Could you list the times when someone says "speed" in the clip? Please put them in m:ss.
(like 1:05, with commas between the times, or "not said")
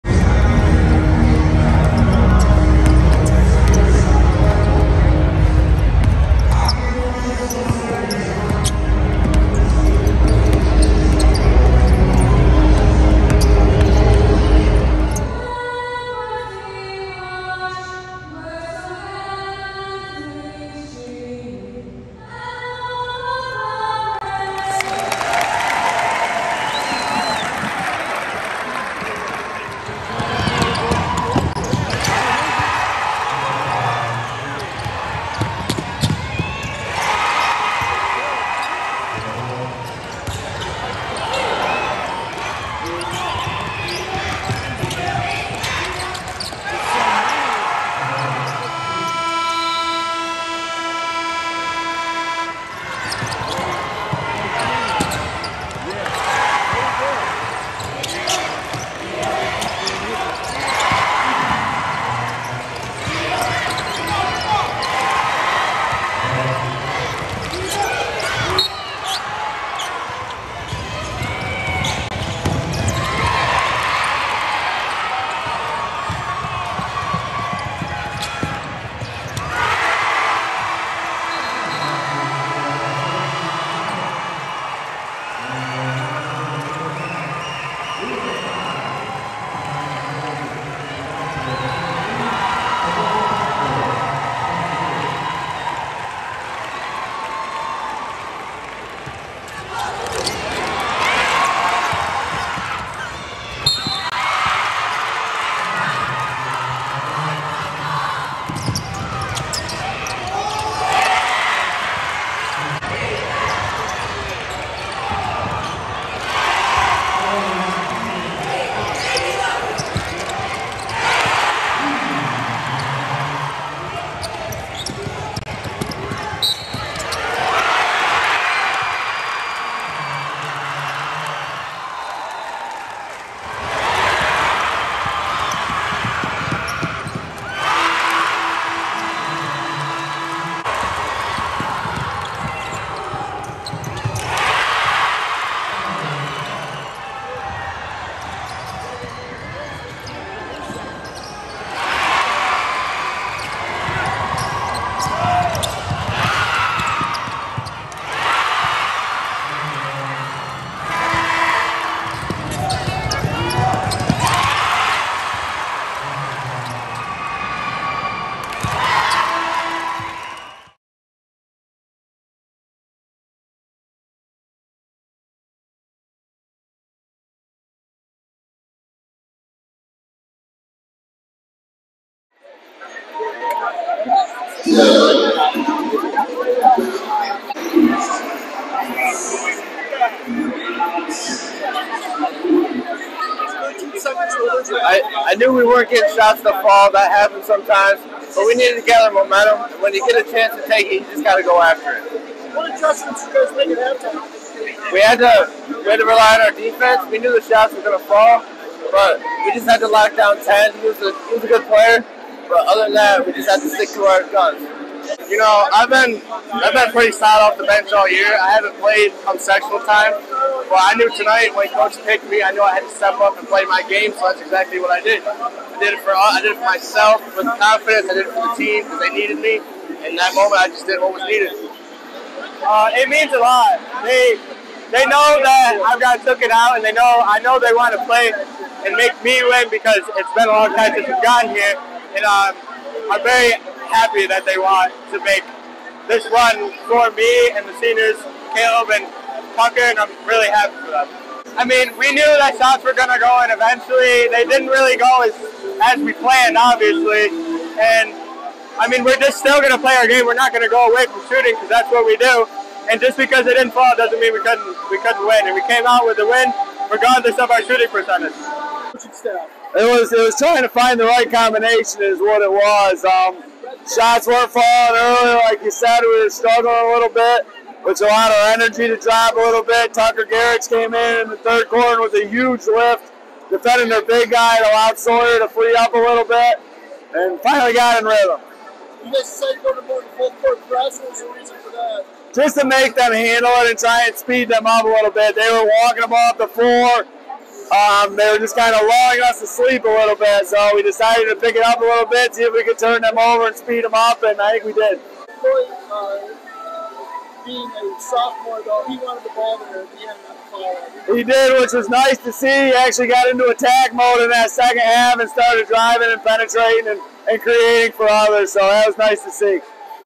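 4:54, 5:03.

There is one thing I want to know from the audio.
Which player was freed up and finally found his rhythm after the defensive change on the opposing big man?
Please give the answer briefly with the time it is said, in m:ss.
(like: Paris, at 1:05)
Sawyer, at 4:44.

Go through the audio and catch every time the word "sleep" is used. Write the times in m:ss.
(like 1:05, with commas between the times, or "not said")
4:59.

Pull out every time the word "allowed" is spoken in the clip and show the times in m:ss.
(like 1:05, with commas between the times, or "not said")
4:38, 4:44.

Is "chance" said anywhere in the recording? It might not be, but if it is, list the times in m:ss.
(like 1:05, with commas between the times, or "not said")
3:20.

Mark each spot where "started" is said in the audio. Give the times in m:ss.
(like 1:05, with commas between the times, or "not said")
5:15.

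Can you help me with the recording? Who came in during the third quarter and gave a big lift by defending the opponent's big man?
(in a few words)
Tucker Garrett.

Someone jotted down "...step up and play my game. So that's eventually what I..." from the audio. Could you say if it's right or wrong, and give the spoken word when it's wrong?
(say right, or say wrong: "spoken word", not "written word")
wrong: "exactly", not "eventually".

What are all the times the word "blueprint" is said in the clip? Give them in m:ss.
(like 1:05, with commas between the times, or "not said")
not said.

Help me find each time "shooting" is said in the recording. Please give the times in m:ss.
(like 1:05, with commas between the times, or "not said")
4:21, 4:27.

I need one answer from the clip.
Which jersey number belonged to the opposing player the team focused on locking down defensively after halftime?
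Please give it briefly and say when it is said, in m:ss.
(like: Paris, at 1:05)
10, at 3:30.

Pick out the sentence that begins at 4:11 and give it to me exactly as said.
I mean, we knew that shots were going to go, and eventually they didn't really go as, as we planned, obviously.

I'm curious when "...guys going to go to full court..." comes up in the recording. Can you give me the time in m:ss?
4:49.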